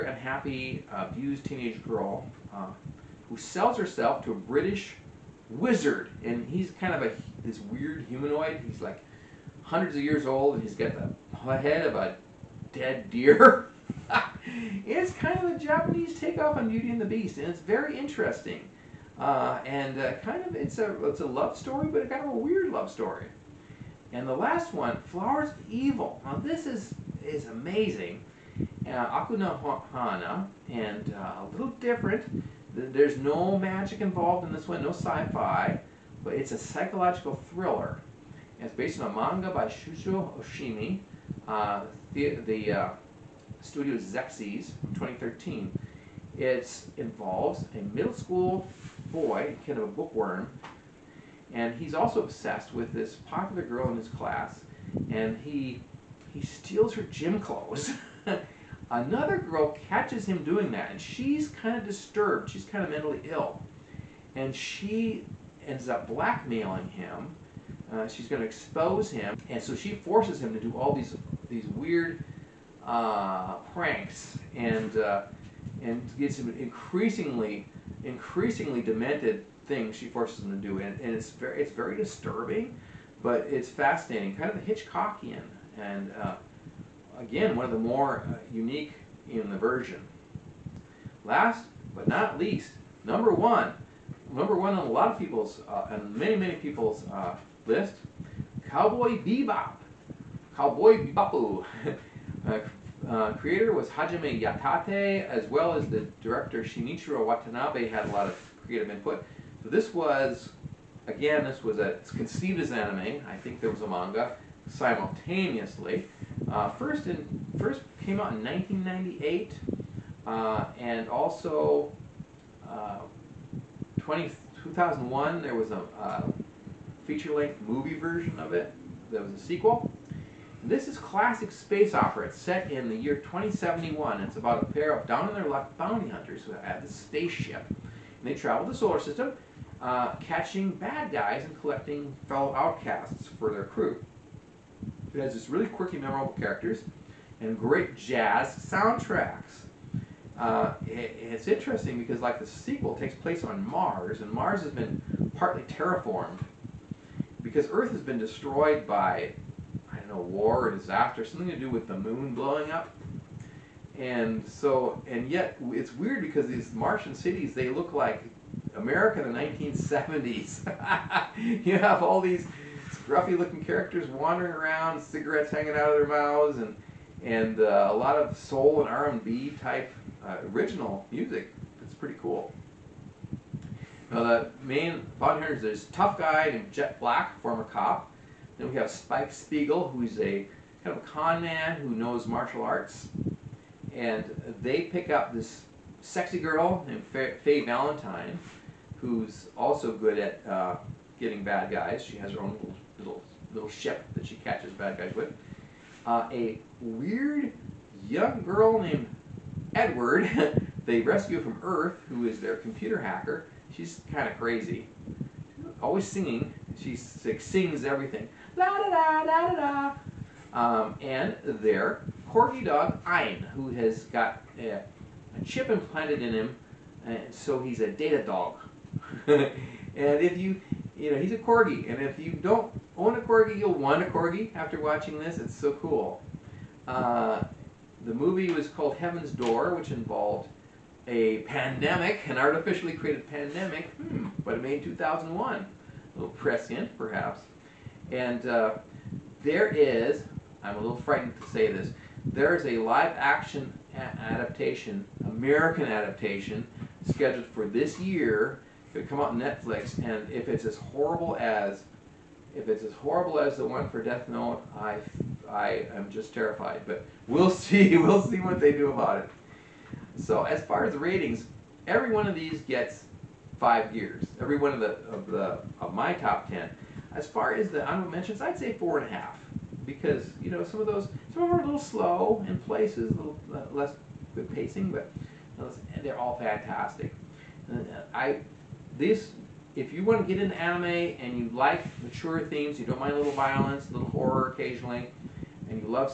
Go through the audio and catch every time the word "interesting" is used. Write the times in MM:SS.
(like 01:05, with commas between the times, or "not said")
00:17, 02:31.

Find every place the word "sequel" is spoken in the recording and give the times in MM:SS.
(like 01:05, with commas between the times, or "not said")
02:09, 02:32.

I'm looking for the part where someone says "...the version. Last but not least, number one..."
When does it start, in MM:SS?
01:29.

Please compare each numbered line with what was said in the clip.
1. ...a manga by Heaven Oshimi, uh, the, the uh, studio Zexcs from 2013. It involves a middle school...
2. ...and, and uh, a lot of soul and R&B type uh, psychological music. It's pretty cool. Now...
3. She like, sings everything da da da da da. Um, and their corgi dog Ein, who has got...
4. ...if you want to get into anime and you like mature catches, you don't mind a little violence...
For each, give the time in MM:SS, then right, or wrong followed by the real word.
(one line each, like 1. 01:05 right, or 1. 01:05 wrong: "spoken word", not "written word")
1. 00:39 wrong: "Shuzo", not "Heaven"
2. 02:56 wrong: "original", not "psychological"
3. 03:36 right
4. 04:49 wrong: "themes", not "catches".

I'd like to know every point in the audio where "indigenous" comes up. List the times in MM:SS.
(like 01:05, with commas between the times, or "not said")
not said.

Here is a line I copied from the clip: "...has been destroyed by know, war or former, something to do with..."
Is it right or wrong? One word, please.
wrong.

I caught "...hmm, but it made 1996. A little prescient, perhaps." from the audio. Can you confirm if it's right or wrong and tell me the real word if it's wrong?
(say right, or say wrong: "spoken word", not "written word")
wrong: "2001", not "1996".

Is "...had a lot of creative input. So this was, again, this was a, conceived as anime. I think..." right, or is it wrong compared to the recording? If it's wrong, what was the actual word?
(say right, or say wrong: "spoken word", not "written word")
right.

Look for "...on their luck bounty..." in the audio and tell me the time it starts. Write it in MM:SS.
02:15.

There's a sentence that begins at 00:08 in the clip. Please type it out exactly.
He's like hundreds of years old, and he's got the head of a dead deer.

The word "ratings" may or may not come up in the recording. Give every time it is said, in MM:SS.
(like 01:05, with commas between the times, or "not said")
04:30.